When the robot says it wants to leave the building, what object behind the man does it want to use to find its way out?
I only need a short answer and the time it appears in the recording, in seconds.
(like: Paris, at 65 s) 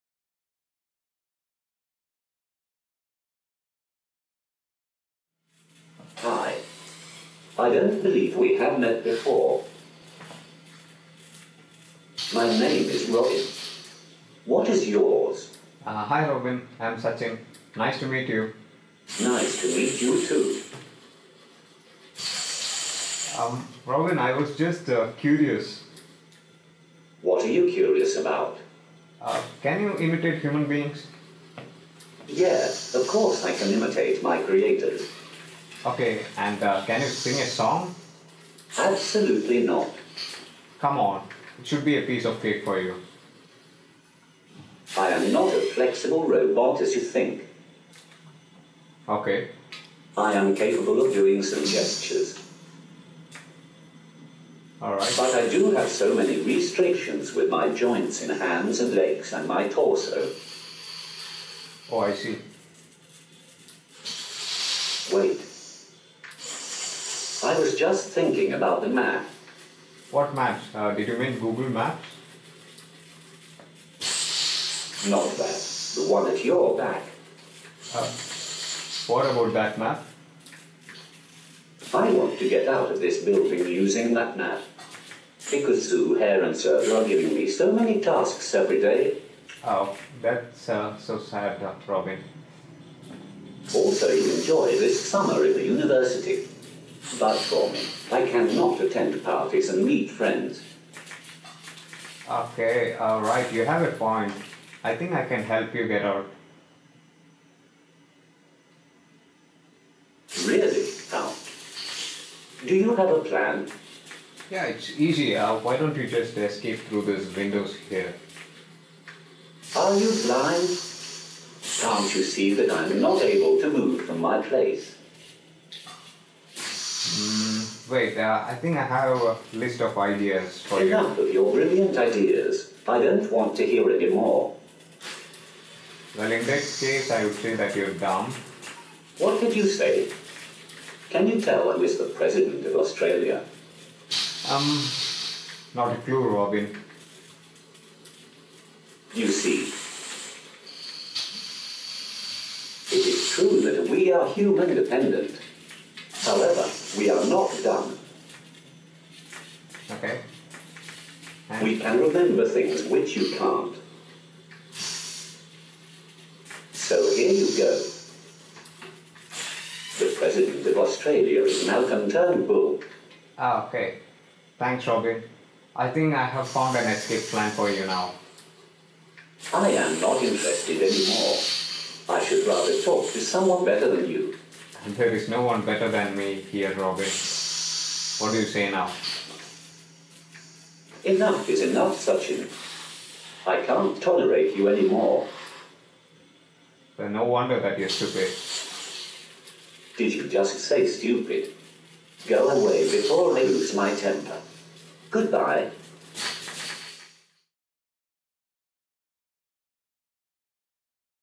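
the map, at 68 s.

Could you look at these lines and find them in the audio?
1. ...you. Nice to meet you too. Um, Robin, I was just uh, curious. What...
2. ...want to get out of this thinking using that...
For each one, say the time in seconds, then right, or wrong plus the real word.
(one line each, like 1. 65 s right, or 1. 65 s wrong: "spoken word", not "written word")
1. 18 s right
2. 82 s wrong: "building", not "thinking".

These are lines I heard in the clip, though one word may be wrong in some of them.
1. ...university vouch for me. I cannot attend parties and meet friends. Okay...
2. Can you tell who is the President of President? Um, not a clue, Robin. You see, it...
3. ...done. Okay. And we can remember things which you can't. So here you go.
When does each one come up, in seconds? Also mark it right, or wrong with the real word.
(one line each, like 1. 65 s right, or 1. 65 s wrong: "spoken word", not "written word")
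1. 95 s right
2. 141 s wrong: "Australia", not "President"
3. 157 s right.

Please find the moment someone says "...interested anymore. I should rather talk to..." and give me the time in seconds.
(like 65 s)
180 s.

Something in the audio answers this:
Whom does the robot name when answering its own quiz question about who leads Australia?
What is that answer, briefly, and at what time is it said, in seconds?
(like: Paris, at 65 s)
Malcolm Turnbull, at 171 s.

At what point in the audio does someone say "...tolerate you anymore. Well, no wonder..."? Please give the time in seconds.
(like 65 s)
194 s.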